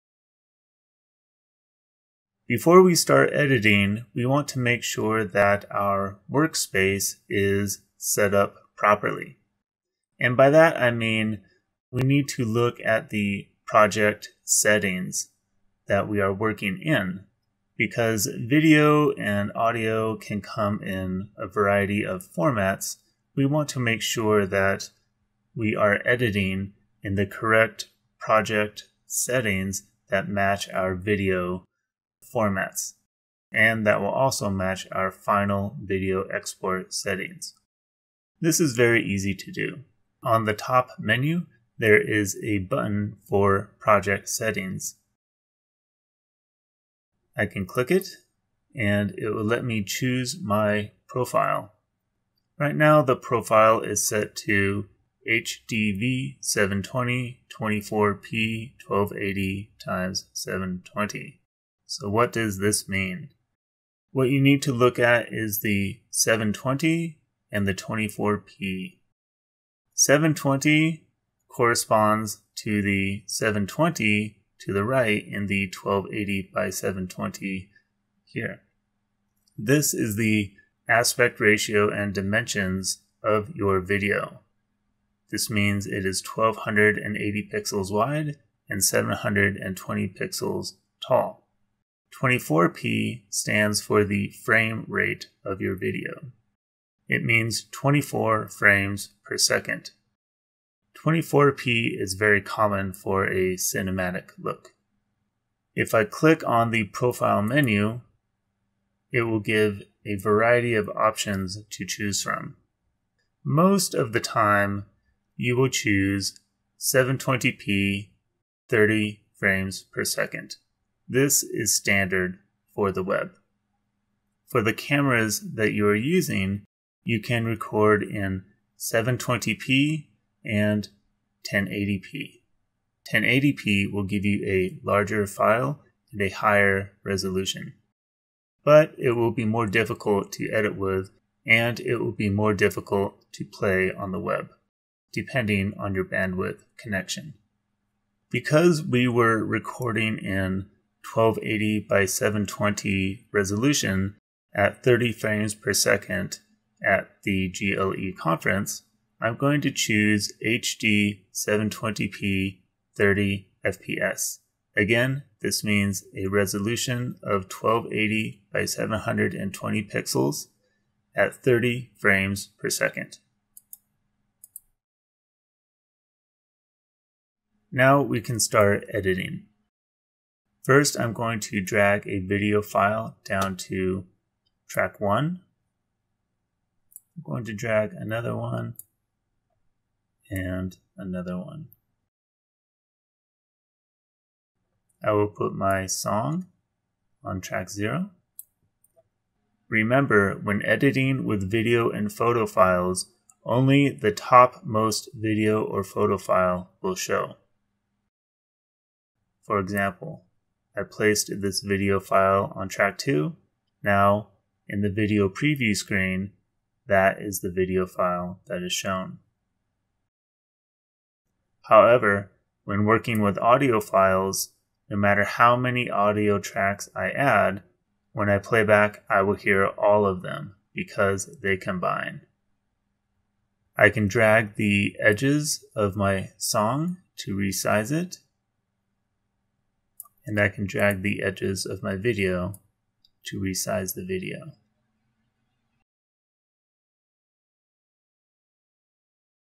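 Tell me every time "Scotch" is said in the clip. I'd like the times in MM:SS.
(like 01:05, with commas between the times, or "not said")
not said.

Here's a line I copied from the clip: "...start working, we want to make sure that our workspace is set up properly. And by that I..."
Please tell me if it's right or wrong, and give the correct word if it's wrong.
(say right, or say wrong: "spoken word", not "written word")
wrong: "editing", not "working".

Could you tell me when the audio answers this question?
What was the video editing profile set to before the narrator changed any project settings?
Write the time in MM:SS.
00:55.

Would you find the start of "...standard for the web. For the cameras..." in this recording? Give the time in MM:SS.
02:01.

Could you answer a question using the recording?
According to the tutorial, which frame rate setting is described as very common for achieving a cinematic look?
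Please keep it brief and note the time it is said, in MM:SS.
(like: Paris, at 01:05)
24p, at 01:41.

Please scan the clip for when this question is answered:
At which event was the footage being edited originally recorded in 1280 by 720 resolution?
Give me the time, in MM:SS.
02:37.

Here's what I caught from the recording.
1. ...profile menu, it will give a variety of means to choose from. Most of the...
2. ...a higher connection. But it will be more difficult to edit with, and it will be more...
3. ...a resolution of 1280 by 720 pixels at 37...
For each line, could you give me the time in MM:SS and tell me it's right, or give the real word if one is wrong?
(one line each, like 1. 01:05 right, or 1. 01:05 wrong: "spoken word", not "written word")
1. 01:46 wrong: "options", not "means"
2. 02:16 wrong: "resolution", not "connection"
3. 02:46 wrong: "30", not "37".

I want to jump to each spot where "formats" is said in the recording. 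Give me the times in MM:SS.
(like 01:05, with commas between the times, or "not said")
00:22, 00:32.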